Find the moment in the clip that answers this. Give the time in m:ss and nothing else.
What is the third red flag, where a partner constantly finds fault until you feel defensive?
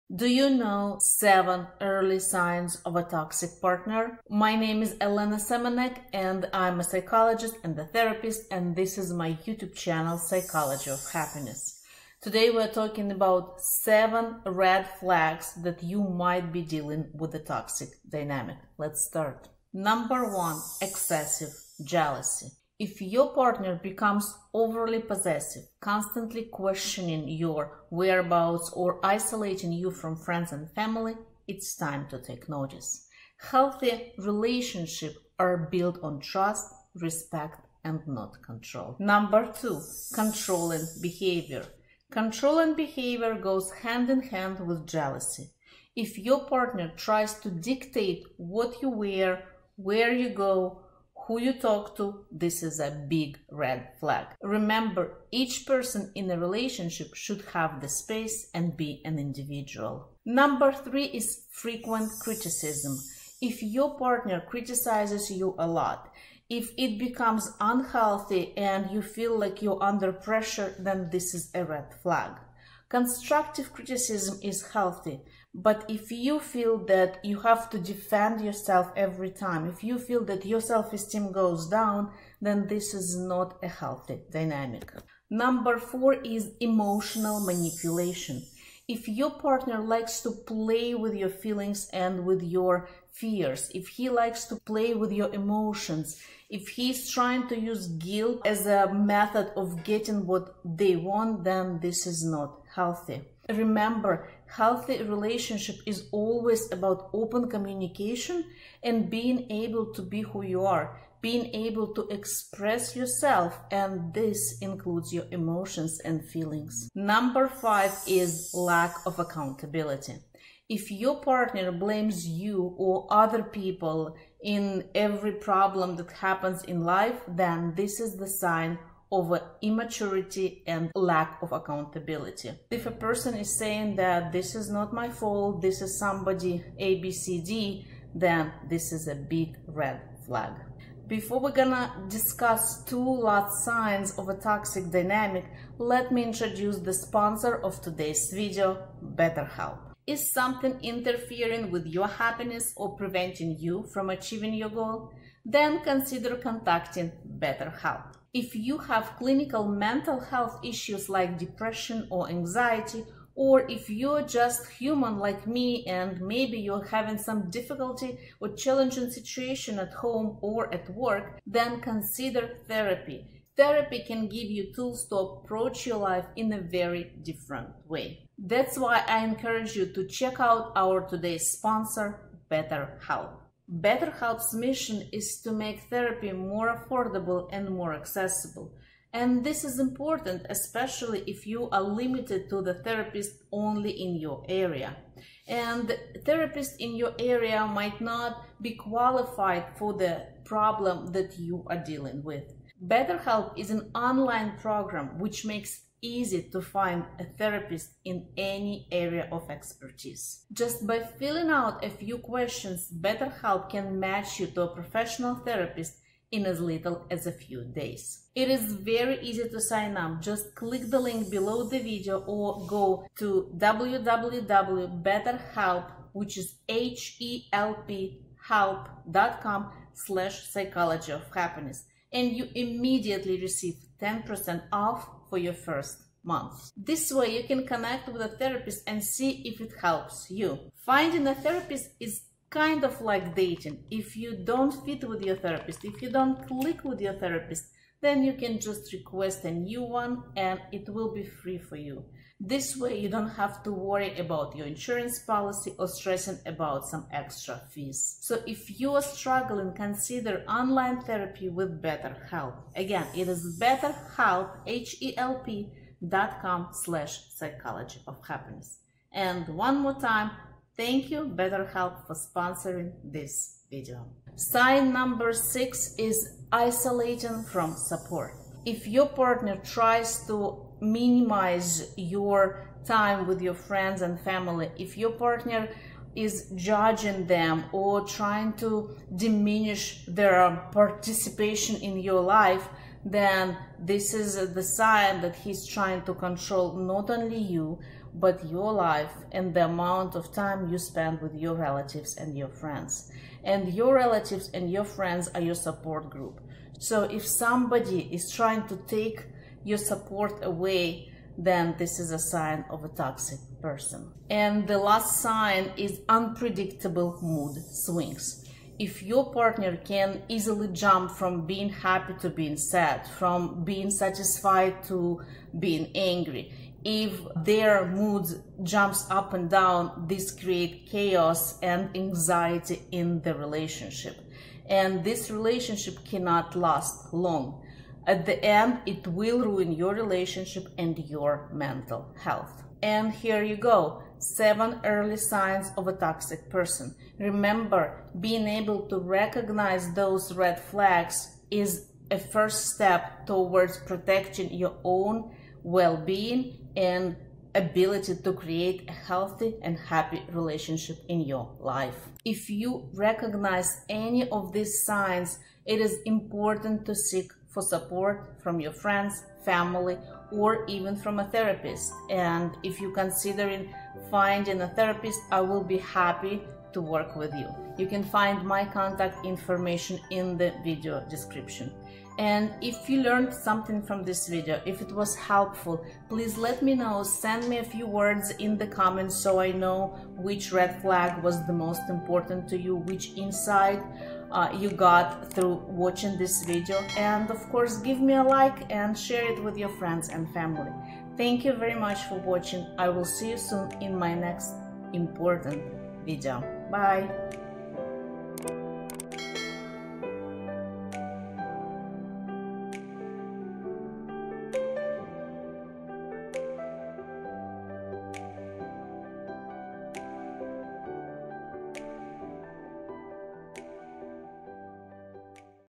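1:01.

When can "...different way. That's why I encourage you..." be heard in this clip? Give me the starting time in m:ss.
2:57.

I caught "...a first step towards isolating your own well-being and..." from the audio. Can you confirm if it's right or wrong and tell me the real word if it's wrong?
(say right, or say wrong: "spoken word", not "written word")
wrong: "protecting", not "isolating".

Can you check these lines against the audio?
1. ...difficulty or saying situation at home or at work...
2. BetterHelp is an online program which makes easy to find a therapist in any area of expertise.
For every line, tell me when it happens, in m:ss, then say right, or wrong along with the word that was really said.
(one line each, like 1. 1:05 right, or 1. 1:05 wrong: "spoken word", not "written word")
1. 2:47 wrong: "challenging", not "saying"
2. 3:22 right.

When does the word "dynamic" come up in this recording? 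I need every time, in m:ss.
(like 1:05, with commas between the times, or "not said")
0:18, 1:24, 2:24.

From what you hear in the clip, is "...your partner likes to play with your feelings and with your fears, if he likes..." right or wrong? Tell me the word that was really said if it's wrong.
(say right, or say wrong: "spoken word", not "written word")
right.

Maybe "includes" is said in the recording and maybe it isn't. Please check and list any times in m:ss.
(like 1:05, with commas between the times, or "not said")
1:54.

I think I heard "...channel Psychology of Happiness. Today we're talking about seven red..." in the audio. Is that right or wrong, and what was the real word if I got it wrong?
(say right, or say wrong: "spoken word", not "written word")
right.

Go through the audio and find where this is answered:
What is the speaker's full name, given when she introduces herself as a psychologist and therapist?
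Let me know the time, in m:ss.
0:04.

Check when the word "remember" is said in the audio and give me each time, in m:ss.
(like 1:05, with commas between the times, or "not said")
0:54, 1:43, 5:47.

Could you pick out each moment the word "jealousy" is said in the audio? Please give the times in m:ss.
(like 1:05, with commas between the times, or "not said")
0:21, 0:44.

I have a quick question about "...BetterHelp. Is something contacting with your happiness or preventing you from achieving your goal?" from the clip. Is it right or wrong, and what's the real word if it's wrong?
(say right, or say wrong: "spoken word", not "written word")
wrong: "interfering", not "contacting".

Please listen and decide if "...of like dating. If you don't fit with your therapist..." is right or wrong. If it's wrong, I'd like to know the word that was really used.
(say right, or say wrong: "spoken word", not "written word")
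right.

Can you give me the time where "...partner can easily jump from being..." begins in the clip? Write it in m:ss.
5:19.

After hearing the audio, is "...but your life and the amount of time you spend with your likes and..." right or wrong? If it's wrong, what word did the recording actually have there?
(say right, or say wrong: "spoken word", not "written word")
wrong: "relatives", not "likes".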